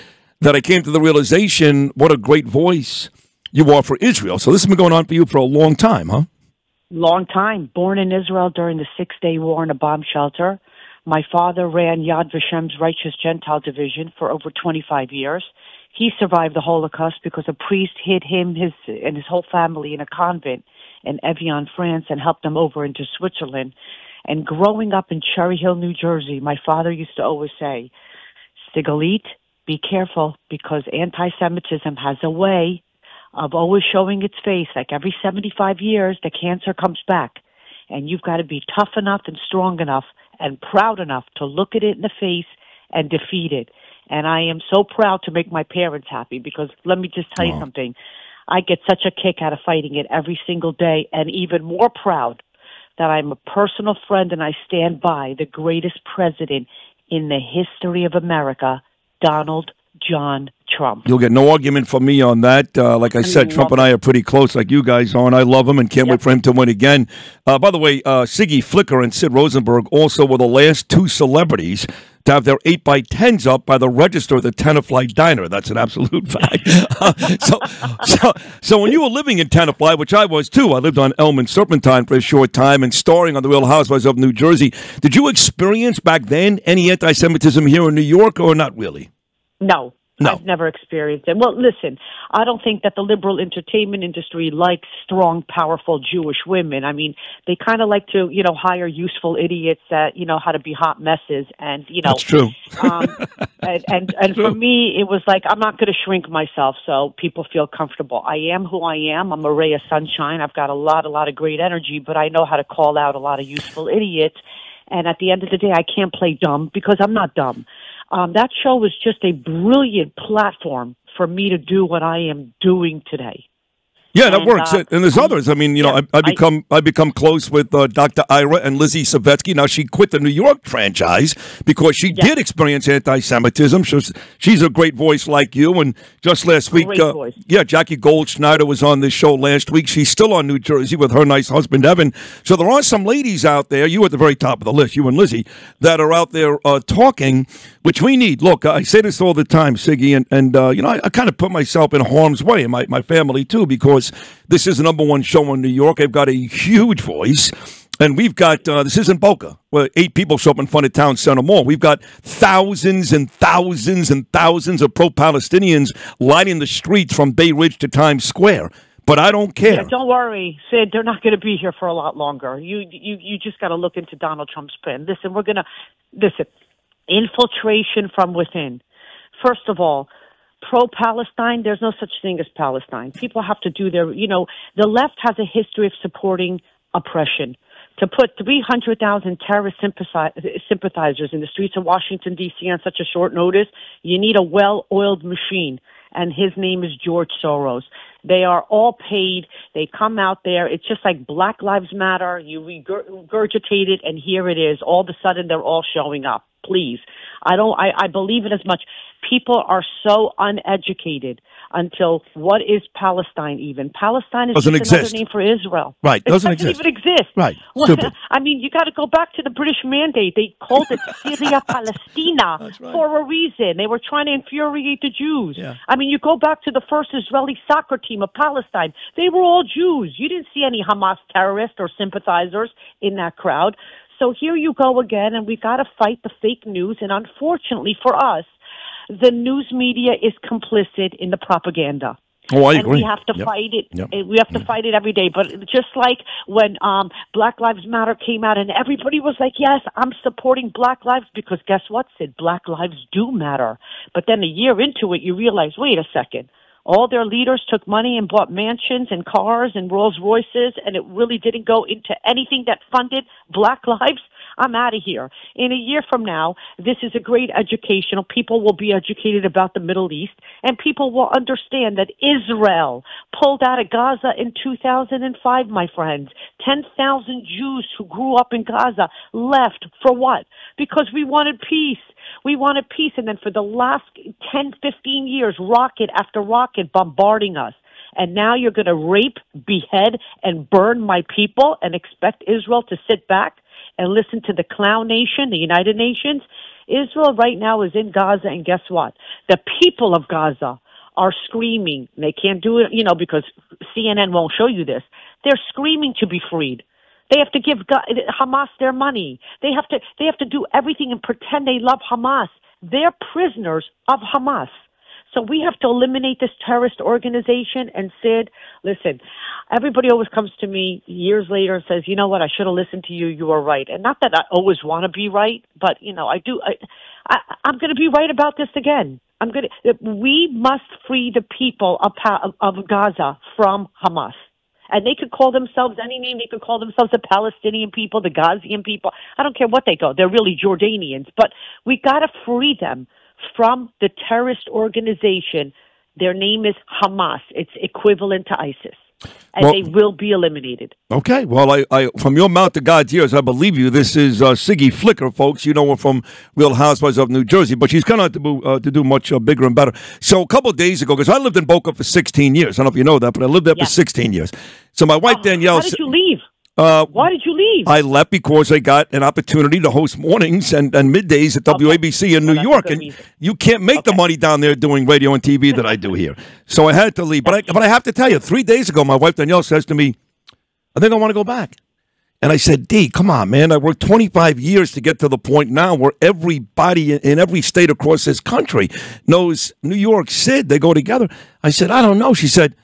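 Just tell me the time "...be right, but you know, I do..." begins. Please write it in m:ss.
5:25.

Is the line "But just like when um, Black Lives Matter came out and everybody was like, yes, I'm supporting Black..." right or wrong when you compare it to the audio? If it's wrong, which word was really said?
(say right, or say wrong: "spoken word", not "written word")
right.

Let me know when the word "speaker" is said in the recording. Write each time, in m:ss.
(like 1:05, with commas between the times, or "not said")
not said.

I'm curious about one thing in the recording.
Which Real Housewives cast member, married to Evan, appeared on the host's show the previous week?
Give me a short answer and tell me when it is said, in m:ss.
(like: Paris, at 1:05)
Jackie Goldschneider, at 2:17.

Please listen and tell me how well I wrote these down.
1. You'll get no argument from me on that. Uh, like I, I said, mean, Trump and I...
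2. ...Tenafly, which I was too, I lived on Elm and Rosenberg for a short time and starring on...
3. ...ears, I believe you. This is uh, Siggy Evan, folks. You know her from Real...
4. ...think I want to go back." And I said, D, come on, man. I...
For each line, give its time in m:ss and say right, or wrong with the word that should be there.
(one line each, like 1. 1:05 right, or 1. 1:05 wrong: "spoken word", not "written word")
1. 1:01 right
2. 1:19 wrong: "Serpentine", not "Rosenberg"
3. 5:53 wrong: "Flicker", not "Evan"
4. 6:21 right.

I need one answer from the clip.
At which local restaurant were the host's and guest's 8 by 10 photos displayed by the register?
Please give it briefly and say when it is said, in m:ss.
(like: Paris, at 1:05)
Tenafly Diner, at 1:14.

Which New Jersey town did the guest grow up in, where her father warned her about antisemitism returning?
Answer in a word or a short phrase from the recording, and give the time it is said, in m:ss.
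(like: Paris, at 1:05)
Cherry Hill, at 0:25.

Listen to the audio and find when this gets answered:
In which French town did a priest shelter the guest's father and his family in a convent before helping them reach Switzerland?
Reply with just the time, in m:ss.
0:21.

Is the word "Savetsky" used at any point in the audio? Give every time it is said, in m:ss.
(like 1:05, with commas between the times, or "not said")
2:09.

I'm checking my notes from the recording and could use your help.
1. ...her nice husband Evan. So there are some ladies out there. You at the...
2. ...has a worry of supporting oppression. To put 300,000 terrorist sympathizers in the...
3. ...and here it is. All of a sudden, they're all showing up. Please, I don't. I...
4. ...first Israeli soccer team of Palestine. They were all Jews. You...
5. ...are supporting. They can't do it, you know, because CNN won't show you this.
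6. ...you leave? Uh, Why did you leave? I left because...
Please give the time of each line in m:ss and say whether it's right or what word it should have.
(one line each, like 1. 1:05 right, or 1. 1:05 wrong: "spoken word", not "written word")
1. 2:21 right
2. 3:05 wrong: "history", not "worry"
3. 3:24 right
4. 3:46 right
5. 5:01 wrong: "screaming", not "supporting"
6. 6:05 right.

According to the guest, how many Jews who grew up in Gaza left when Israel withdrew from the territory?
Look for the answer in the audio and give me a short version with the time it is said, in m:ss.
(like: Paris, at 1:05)
10,000, at 4:36.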